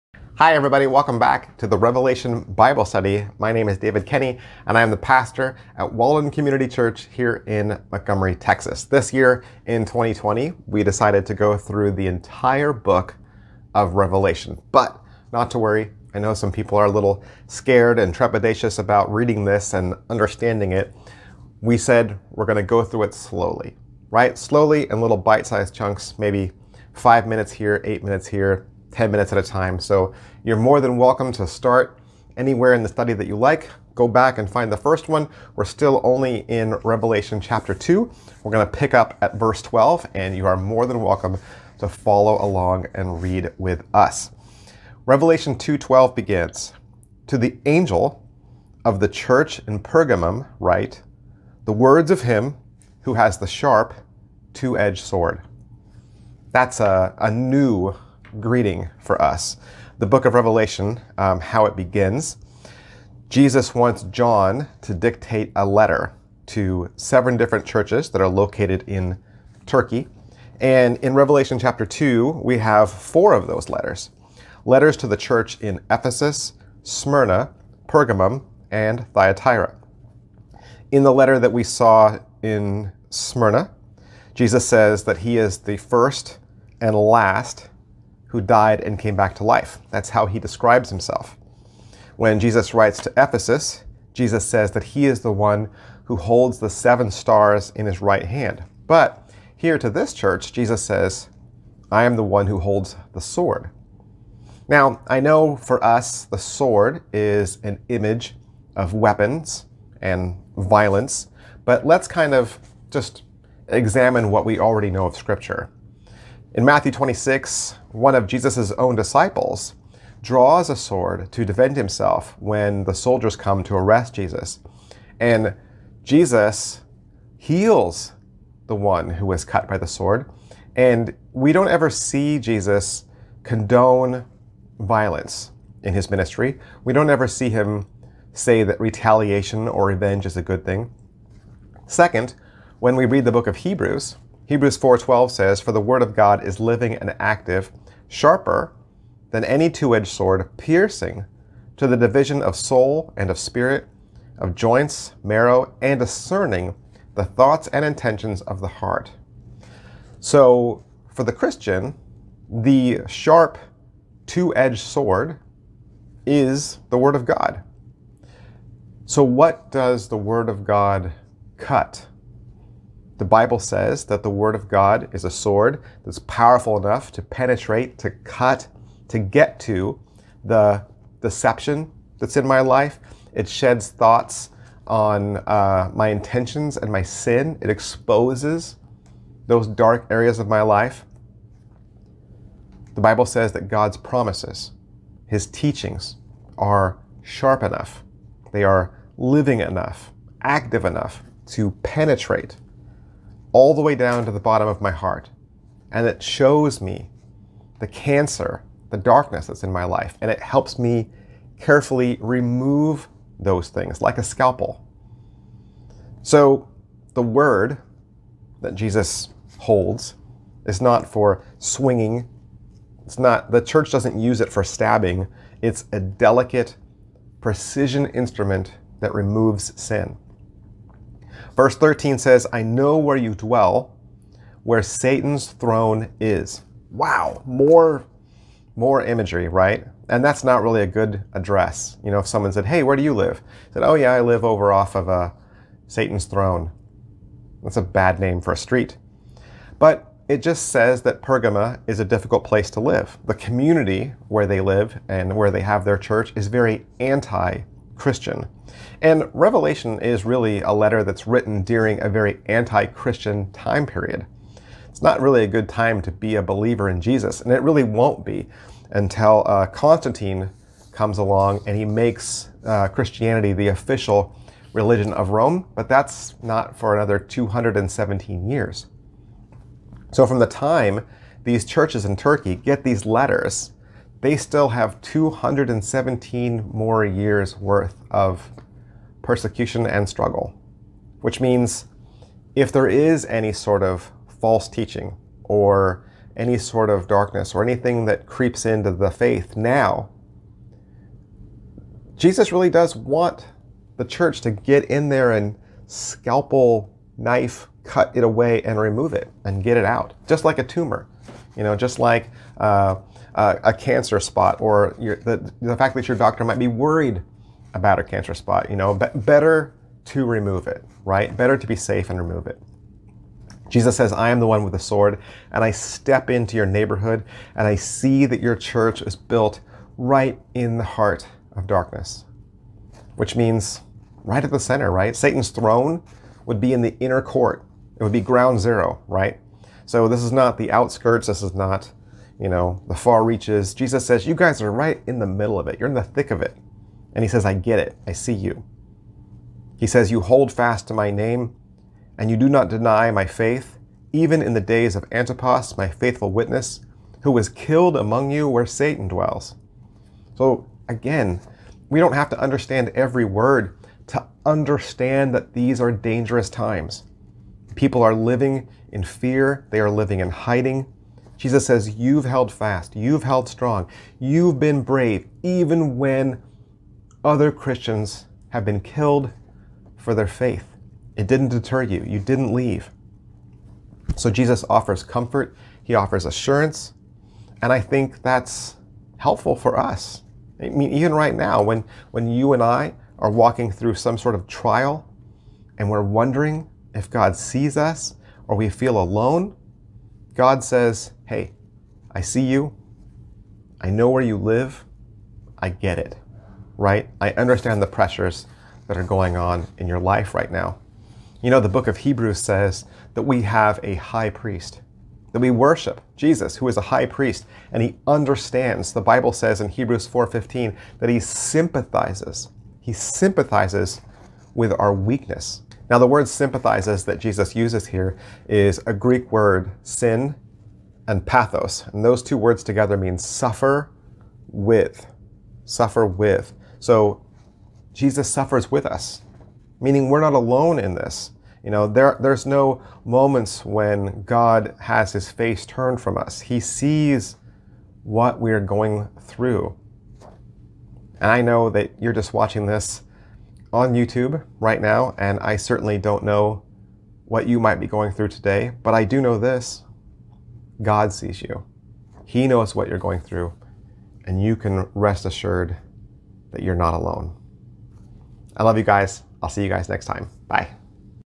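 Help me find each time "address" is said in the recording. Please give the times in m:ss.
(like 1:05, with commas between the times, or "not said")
4:01.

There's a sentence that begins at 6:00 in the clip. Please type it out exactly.
So again, we don't have to understand every word to understand that these are dangerous times.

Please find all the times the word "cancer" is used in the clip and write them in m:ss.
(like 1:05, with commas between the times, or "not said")
3:27, 5:13, 5:18.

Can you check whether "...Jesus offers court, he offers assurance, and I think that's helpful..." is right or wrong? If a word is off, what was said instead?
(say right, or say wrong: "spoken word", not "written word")
wrong: "comfort", not "court".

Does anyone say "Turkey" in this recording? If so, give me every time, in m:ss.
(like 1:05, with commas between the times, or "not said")
1:09, 4:42.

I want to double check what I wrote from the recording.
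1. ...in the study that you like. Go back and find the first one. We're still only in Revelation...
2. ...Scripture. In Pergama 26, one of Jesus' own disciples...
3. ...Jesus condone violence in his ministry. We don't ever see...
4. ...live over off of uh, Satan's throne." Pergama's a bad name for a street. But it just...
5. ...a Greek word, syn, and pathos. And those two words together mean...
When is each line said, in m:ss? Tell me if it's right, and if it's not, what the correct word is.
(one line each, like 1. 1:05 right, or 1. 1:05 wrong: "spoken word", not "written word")
1. 0:32 right
2. 1:55 wrong: "Matthew", not "Pergama"
3. 2:12 right
4. 4:04 wrong: "That", not "Pergama"
5. 7:08 right.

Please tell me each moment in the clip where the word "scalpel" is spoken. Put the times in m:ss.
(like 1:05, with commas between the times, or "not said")
3:34, 5:05.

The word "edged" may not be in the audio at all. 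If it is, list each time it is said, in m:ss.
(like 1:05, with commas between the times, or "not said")
0:54, 2:29, 2:44.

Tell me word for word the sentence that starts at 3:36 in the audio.
So the word that Jesus holds is not for swinging.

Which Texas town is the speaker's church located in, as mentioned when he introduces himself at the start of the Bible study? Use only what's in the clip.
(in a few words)
Montgomery.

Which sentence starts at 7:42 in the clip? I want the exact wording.
He knows what you're going through, and you can rest assured that you're not alone.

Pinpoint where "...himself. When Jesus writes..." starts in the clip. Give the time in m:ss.
1:30.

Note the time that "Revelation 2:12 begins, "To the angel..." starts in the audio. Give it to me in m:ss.
0:45.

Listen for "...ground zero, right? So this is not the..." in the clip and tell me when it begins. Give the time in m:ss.
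5:38.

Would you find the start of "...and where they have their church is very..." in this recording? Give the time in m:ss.
4:15.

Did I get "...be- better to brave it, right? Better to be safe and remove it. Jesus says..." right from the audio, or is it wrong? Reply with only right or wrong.
wrong.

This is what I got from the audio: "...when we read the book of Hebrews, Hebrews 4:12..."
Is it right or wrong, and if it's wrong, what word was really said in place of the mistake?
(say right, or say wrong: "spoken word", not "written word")
right.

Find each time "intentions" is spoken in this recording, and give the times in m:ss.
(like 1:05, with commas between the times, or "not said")
2:37, 3:06.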